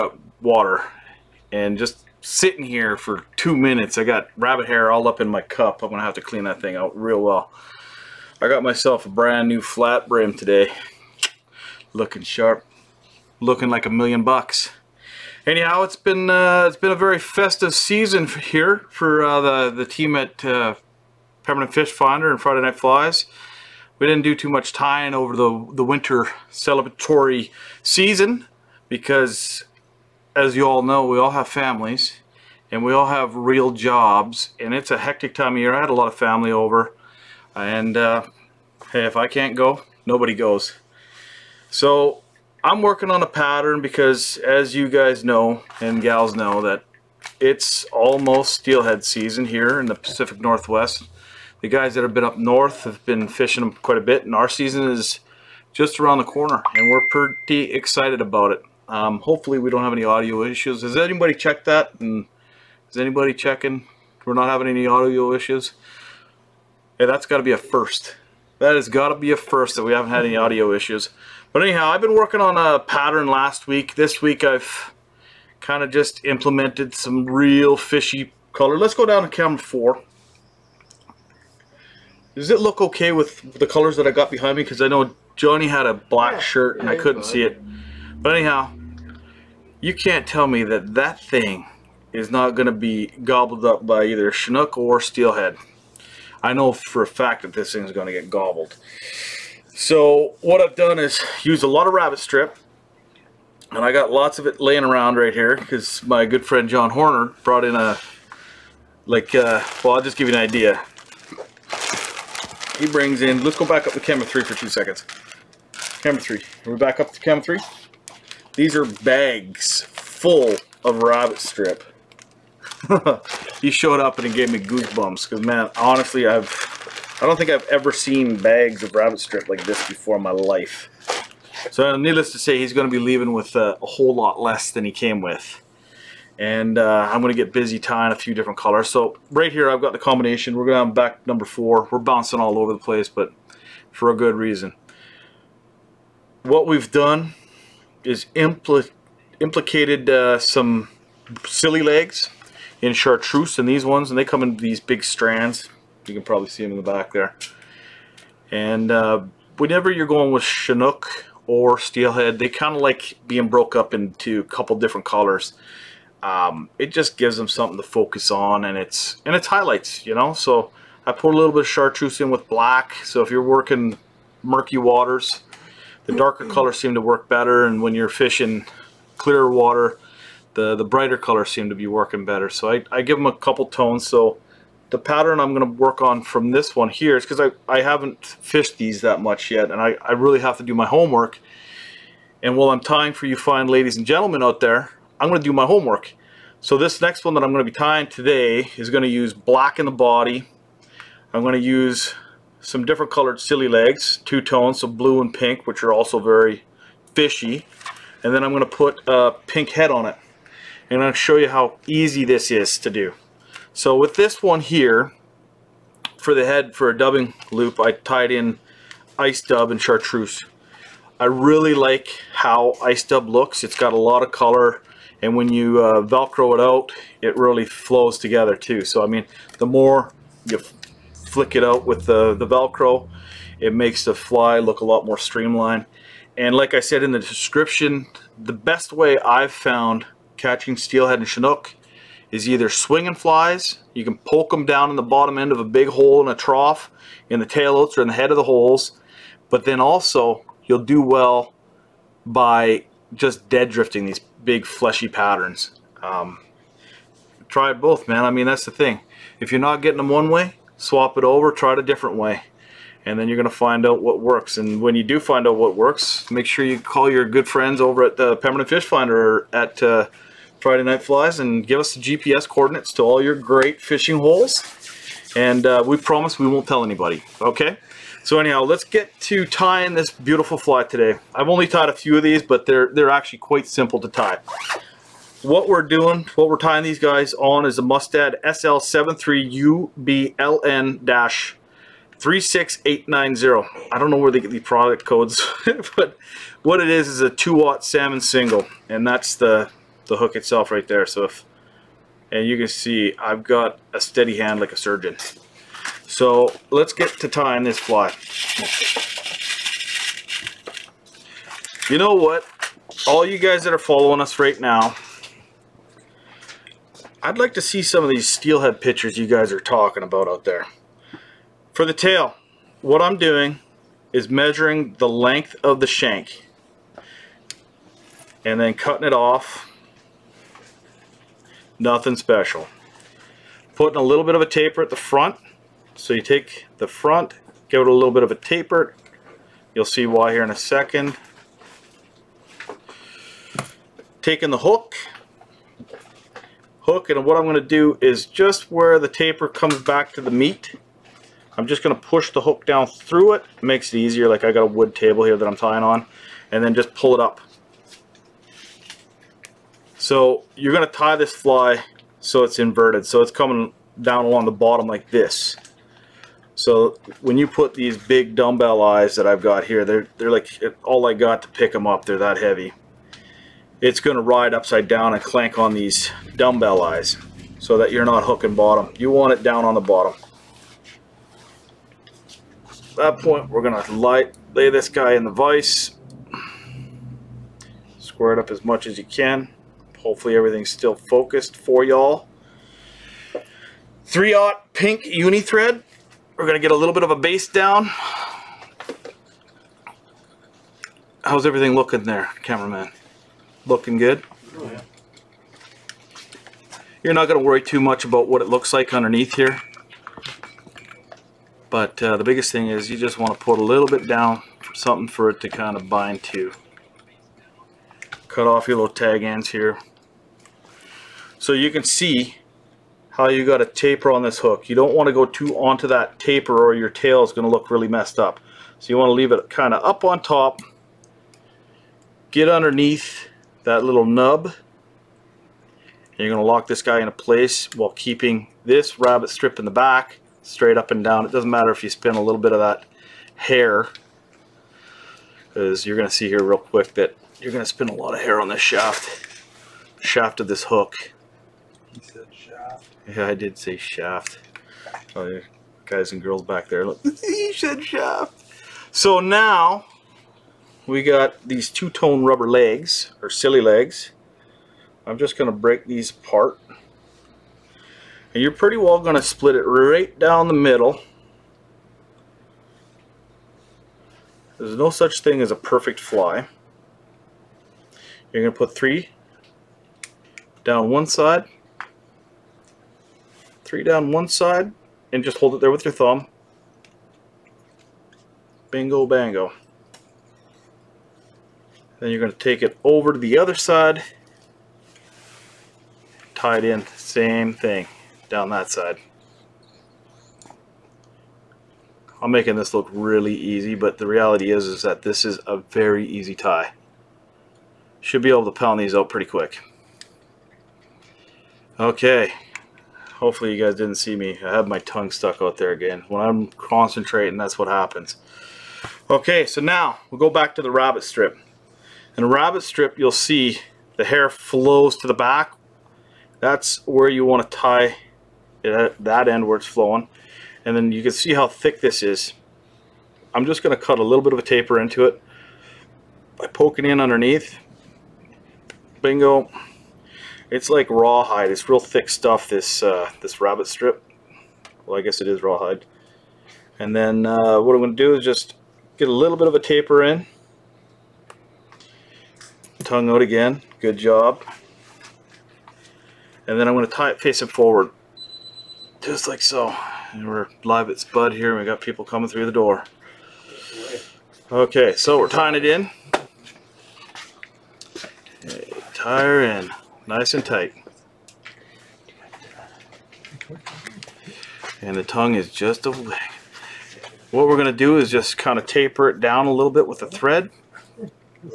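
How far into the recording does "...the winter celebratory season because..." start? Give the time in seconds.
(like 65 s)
25 s.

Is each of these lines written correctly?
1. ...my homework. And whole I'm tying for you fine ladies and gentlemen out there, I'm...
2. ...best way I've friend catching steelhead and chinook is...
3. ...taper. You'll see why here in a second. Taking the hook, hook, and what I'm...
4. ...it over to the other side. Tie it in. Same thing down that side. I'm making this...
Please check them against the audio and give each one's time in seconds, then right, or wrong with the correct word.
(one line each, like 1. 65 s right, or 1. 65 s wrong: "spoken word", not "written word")
1. 190 s wrong: "while", not "whole"
2. 238 s wrong: "found", not "friend"
3. 338 s right
4. 492 s right.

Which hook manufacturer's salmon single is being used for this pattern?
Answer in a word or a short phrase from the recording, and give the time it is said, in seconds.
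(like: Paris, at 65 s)
Mustad, at 287 s.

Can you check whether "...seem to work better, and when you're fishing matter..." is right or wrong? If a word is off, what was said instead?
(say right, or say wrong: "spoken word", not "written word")
wrong: "clearer", not "matter".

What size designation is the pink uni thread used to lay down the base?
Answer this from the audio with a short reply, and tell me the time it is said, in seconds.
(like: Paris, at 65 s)
3/0, at 394 s.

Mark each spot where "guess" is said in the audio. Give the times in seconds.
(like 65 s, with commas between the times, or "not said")
545 s.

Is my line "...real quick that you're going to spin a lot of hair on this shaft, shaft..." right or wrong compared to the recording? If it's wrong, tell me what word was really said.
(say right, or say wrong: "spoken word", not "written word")
right.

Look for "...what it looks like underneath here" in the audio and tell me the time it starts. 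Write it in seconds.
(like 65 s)
408 s.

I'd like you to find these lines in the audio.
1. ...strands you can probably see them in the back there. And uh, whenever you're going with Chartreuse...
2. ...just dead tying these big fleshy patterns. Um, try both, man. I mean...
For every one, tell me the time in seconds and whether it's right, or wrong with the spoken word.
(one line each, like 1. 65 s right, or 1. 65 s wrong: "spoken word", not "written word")
1. 155 s wrong: "Chinook", not "Chartreuse"
2. 253 s wrong: "drifting", not "tying".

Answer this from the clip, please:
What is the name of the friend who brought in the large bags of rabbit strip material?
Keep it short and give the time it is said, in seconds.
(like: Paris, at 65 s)
John Horner, at 106 s.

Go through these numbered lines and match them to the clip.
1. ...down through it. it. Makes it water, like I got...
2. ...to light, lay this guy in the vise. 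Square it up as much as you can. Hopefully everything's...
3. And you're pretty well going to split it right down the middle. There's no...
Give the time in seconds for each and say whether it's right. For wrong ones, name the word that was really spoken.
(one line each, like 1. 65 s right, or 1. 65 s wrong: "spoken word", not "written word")
1. 352 s wrong: "easier", not "water"
2. 383 s right
3. 468 s right.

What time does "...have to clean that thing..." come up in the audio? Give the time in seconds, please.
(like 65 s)
6 s.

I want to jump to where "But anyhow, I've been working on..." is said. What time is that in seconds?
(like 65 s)
71 s.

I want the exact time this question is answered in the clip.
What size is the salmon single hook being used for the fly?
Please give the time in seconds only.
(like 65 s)
297 s.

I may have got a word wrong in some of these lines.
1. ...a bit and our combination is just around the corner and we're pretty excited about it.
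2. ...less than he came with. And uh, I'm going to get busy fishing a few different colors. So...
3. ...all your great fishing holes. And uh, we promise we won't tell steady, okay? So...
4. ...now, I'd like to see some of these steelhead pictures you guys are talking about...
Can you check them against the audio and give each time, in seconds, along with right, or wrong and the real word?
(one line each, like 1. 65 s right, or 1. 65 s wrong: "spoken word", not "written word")
1. 53 s wrong: "season", not "combination"
2. 134 s wrong: "tying", not "fishing"
3. 273 s wrong: "anybody", not "steady"
4. 314 s right.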